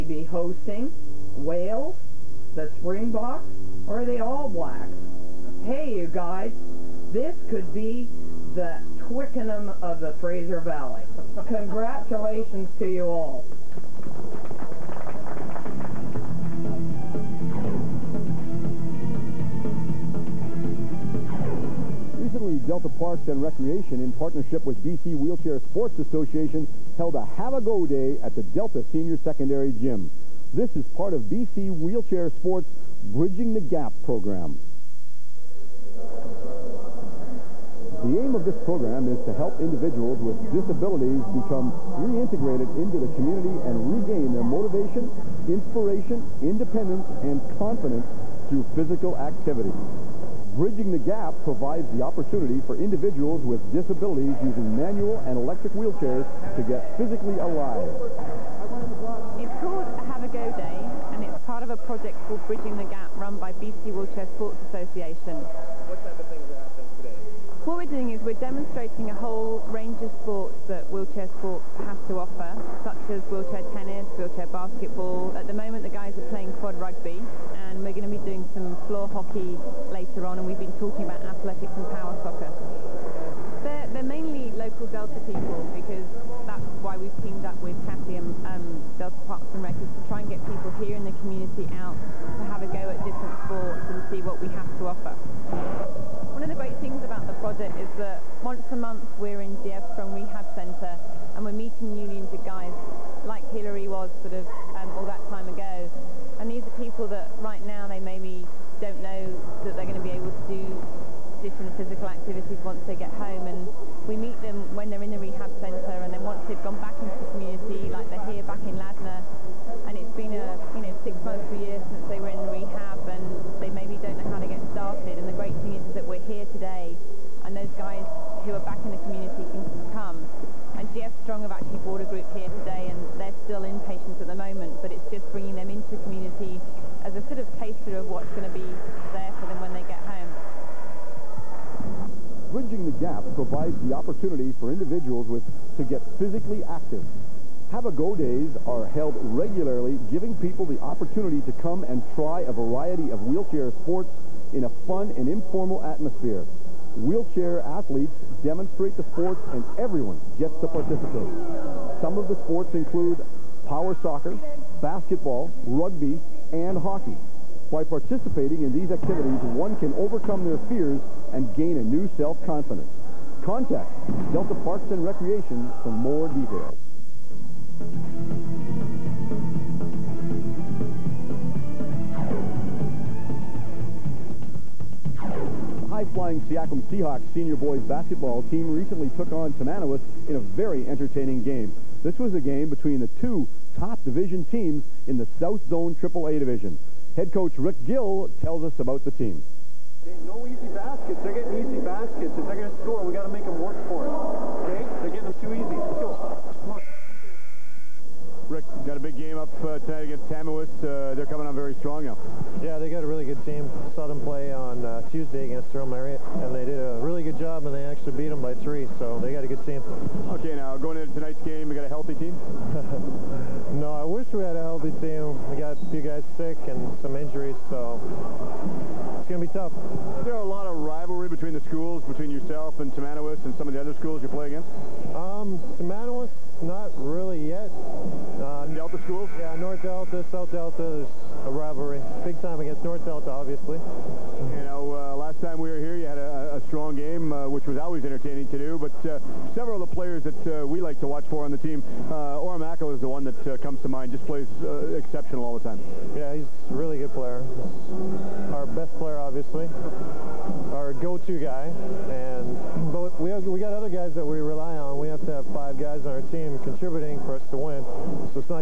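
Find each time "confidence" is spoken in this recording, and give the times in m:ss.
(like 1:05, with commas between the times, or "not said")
0:47, 2:52.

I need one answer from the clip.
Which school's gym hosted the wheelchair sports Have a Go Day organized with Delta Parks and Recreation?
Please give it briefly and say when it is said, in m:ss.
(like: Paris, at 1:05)
Delta Senior Secondary, at 0:28.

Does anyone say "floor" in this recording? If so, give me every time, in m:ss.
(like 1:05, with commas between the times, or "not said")
1:18.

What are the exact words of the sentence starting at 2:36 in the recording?
Wheelchair athletes demonstrate the sports and everyone gets to participate.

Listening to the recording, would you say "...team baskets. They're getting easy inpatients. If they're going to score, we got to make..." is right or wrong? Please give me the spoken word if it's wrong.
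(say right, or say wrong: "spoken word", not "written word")
wrong: "baskets", not "inpatients".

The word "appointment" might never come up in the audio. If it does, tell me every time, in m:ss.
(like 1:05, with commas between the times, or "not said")
not said.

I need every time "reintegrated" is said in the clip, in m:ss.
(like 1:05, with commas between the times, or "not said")
0:42.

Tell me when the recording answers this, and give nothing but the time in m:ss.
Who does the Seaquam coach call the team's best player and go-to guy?
4:12.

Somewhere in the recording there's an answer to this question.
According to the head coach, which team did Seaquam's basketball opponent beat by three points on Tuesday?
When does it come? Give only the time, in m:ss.
3:35.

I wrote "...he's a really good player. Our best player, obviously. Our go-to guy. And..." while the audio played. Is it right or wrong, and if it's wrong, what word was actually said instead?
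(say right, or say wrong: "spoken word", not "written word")
right.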